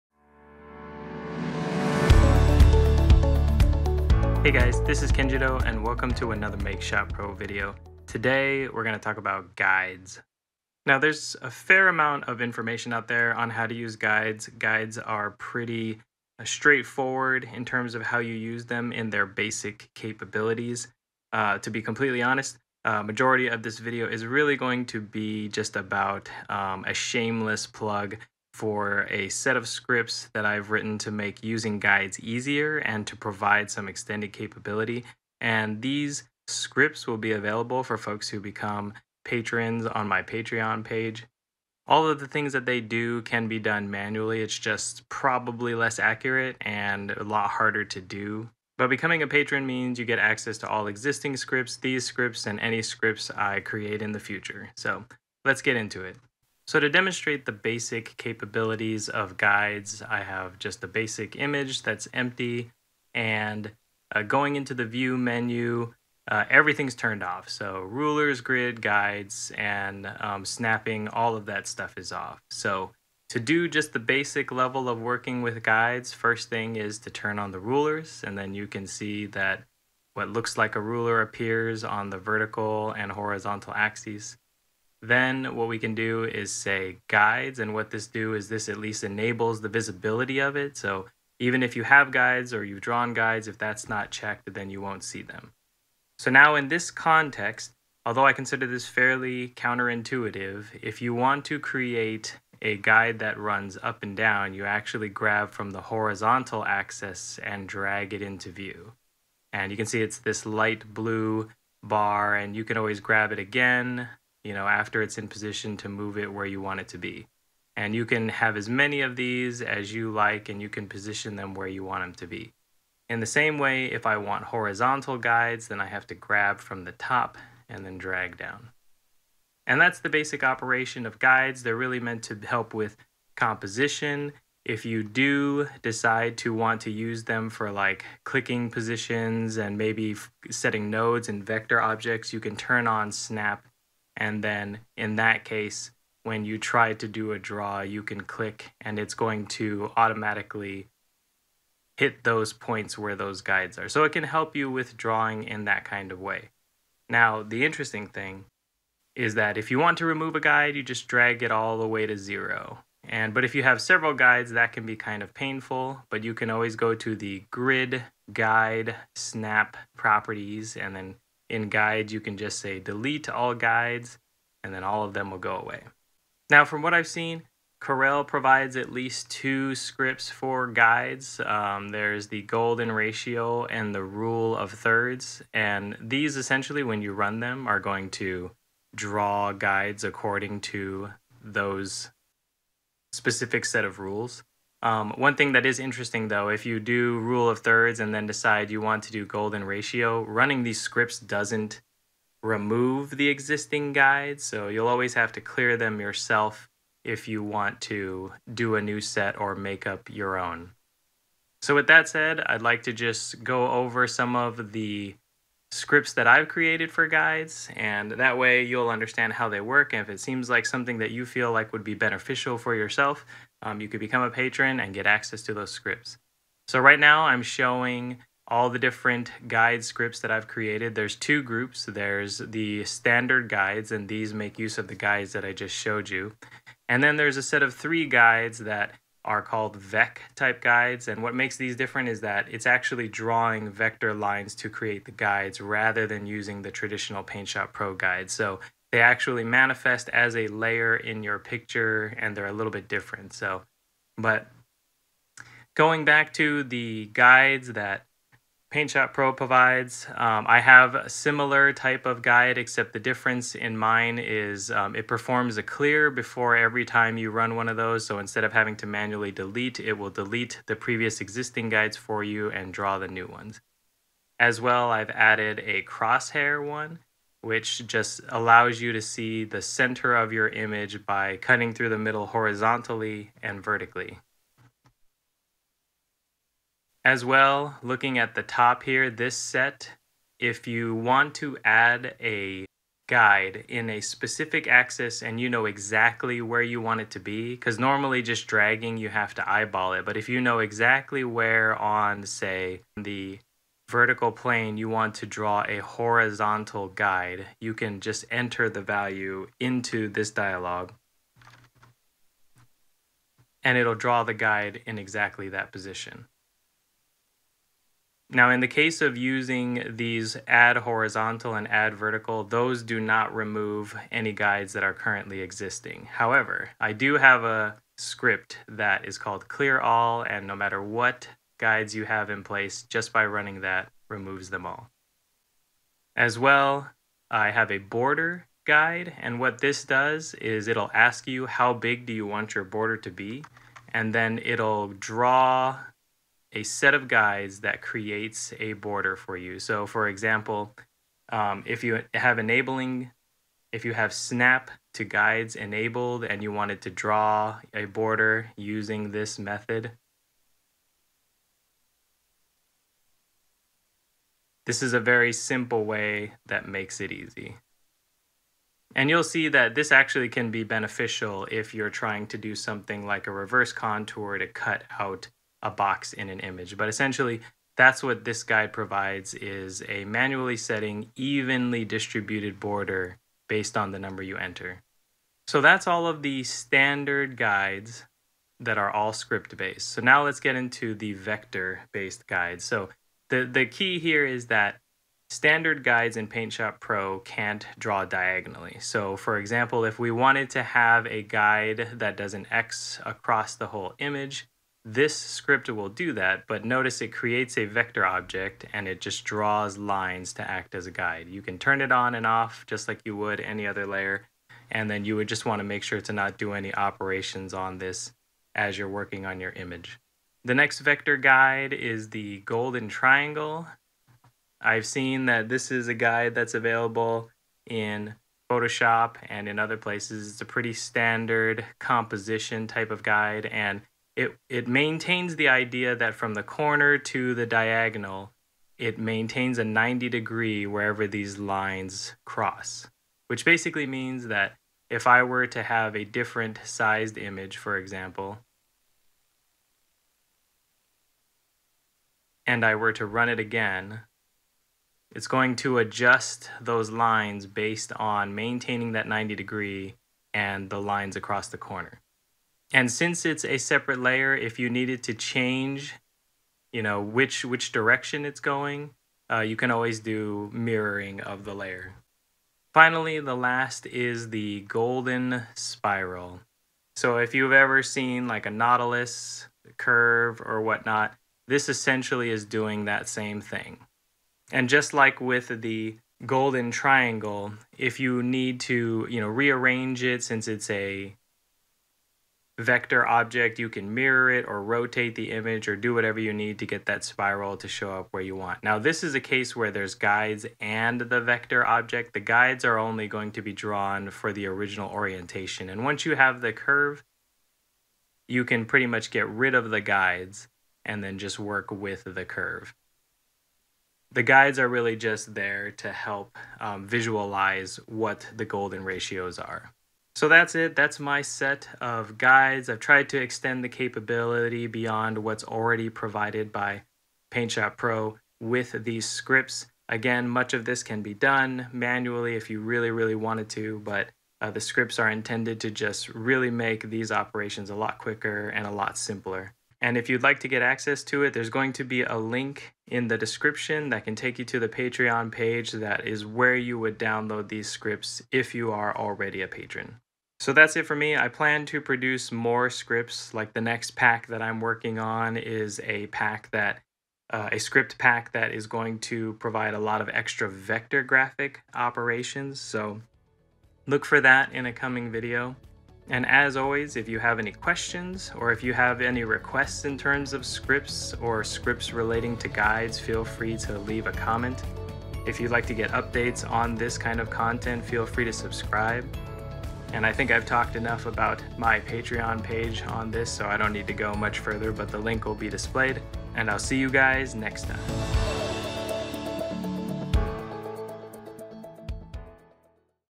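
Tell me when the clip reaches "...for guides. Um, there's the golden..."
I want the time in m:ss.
3:00.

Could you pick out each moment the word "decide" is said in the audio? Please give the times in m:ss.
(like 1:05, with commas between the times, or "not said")
2:15, 3:18.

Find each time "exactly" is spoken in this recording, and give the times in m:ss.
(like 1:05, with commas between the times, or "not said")
4:55, 5:00, 5:14.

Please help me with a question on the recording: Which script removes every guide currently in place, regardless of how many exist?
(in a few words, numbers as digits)
clear all.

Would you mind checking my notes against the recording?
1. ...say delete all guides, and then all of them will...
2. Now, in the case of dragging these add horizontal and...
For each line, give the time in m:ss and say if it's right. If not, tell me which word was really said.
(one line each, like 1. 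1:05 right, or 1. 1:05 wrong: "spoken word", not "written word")
1. 2:52 right
2. 5:18 wrong: "using", not "dragging".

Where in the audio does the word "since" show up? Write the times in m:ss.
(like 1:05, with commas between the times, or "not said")
7:42, 8:10.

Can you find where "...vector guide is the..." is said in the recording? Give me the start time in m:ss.
7:00.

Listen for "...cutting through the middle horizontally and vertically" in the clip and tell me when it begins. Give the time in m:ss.
4:41.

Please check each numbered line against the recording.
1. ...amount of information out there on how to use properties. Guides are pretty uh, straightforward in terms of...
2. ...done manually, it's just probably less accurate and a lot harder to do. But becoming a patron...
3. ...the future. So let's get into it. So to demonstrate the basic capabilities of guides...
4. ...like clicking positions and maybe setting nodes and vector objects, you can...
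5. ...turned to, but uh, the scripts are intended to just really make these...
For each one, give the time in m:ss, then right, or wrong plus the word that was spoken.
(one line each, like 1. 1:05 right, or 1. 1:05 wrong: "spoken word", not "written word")
1. 0:11 wrong: "guides", not "properties"
2. 0:43 right
3. 0:54 right
4. 2:17 right
5. 8:53 wrong: "wanted", not "turned".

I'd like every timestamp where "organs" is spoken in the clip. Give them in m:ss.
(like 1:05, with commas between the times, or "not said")
not said.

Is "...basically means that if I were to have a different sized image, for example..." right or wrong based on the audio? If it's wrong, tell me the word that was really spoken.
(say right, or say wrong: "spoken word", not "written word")
right.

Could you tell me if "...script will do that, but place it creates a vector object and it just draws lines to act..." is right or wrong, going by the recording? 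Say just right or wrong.
wrong.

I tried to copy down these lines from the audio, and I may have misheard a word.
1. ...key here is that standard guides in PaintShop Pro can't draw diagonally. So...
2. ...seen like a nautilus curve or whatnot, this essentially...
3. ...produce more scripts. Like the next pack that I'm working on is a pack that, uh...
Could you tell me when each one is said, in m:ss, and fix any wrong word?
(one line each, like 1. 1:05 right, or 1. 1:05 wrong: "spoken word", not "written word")
1. 6:33 right
2. 7:57 right
3. 9:11 right.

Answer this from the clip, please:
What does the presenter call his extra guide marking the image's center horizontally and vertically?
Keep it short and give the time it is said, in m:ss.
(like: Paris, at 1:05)
crosshair, at 4:35.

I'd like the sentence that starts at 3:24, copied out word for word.
So you'll always have to clear them yourself if you want to do a new set or make up your own.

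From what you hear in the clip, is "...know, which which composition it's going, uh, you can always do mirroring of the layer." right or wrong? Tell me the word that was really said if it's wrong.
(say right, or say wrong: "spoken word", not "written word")
wrong: "direction", not "composition".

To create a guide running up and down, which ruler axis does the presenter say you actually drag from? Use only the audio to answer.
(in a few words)
horizontal axis.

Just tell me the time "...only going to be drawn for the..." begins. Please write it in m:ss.
8:22.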